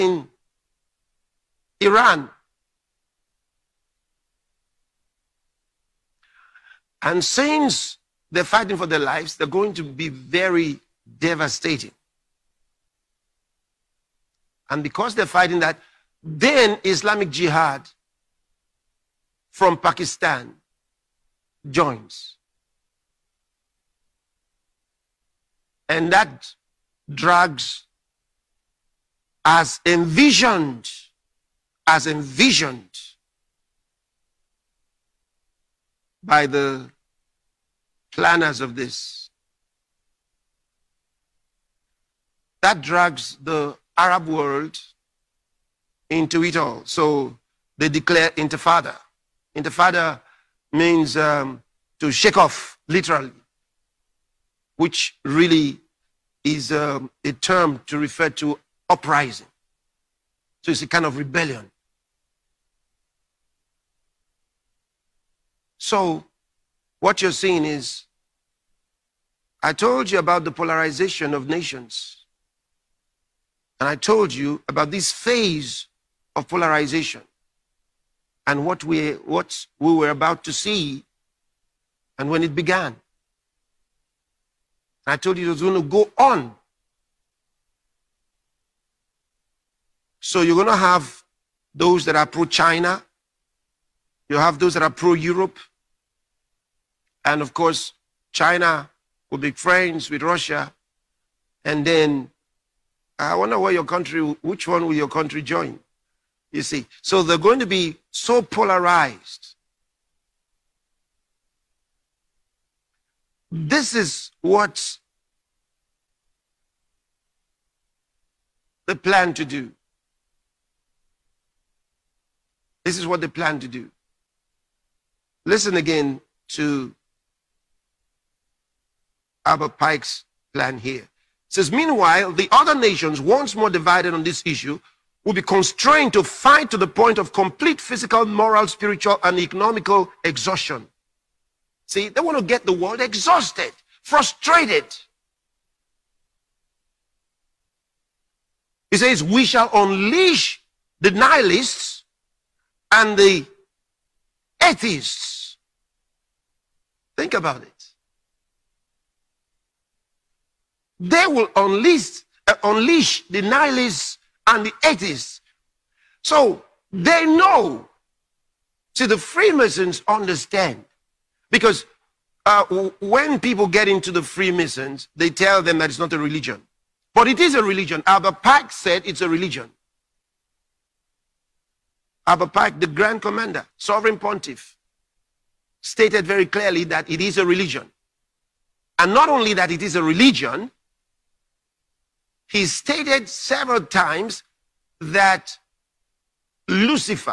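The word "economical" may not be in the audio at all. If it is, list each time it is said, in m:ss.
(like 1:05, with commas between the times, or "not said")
2:19.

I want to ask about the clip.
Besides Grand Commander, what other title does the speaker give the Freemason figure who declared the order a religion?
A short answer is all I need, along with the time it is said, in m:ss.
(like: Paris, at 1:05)
Sovereign Pontiff, at 3:03.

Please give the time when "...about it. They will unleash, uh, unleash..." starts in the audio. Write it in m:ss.
2:37.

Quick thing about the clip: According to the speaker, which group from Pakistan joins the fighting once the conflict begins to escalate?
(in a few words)
Islamic Jihad.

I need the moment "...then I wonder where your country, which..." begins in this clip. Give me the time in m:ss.
1:41.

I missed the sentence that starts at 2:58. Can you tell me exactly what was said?
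Albert Pike said it's a religion.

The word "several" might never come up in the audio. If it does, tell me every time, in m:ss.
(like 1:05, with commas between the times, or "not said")
3:13.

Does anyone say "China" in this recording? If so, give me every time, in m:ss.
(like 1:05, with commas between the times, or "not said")
1:32, 1:38.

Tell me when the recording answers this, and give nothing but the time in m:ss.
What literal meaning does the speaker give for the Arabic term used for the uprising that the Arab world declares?
0:51.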